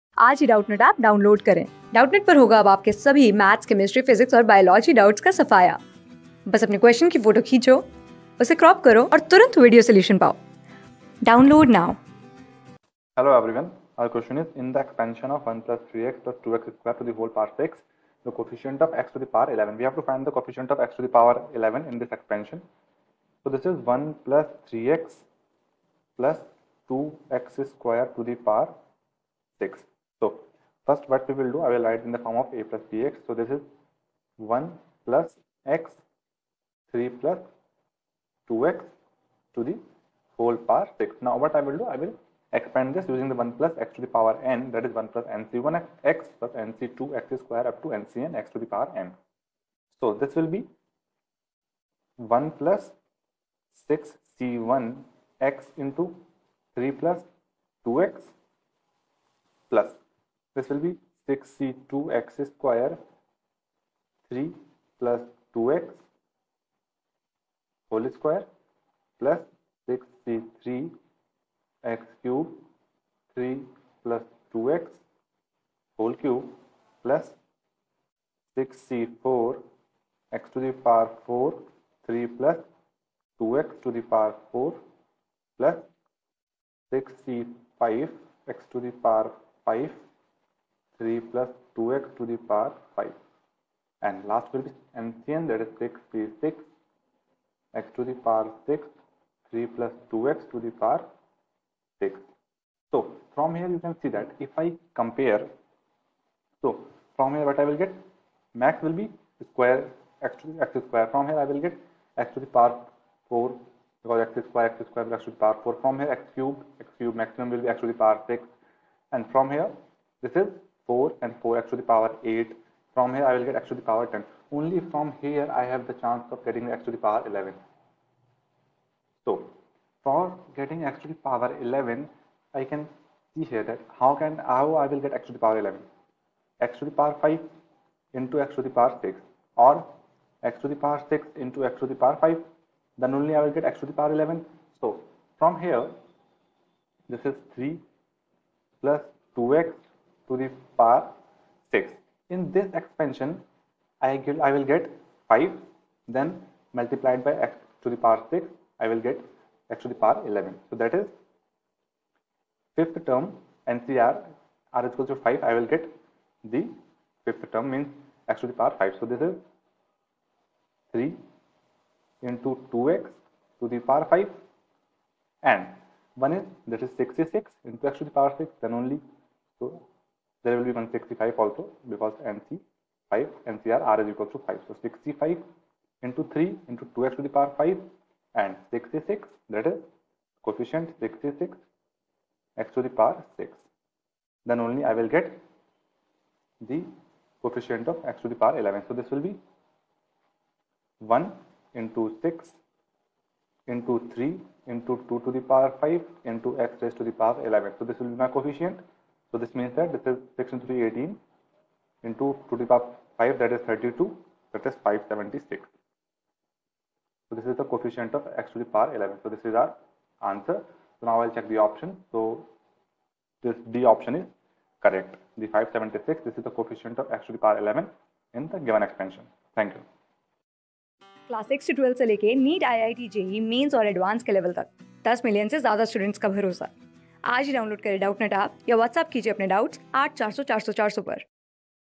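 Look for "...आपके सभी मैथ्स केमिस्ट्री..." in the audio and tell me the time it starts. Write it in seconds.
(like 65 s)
2 s.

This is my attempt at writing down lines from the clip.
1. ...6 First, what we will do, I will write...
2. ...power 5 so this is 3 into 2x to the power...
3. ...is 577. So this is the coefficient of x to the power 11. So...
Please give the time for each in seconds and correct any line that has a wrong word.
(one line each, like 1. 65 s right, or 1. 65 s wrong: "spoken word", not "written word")
1. 29 s right
2. 168 s right
3. 214 s wrong: "576", not "577".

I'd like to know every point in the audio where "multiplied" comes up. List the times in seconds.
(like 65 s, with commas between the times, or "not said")
156 s.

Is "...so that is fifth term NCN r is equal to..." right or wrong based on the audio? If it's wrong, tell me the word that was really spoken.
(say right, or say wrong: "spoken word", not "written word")
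wrong: "NCR", not "NCN".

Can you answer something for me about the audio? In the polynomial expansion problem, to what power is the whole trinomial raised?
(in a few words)
6.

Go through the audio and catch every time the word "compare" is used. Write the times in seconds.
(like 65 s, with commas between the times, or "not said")
105 s.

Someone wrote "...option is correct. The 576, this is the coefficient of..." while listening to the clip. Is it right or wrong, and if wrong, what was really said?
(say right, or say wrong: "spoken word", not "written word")
right.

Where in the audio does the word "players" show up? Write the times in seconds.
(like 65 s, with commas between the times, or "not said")
not said.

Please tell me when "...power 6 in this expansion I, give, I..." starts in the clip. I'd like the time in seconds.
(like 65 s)
150 s.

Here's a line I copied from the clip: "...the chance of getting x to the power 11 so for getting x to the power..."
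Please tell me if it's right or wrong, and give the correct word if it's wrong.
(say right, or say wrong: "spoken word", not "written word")
right.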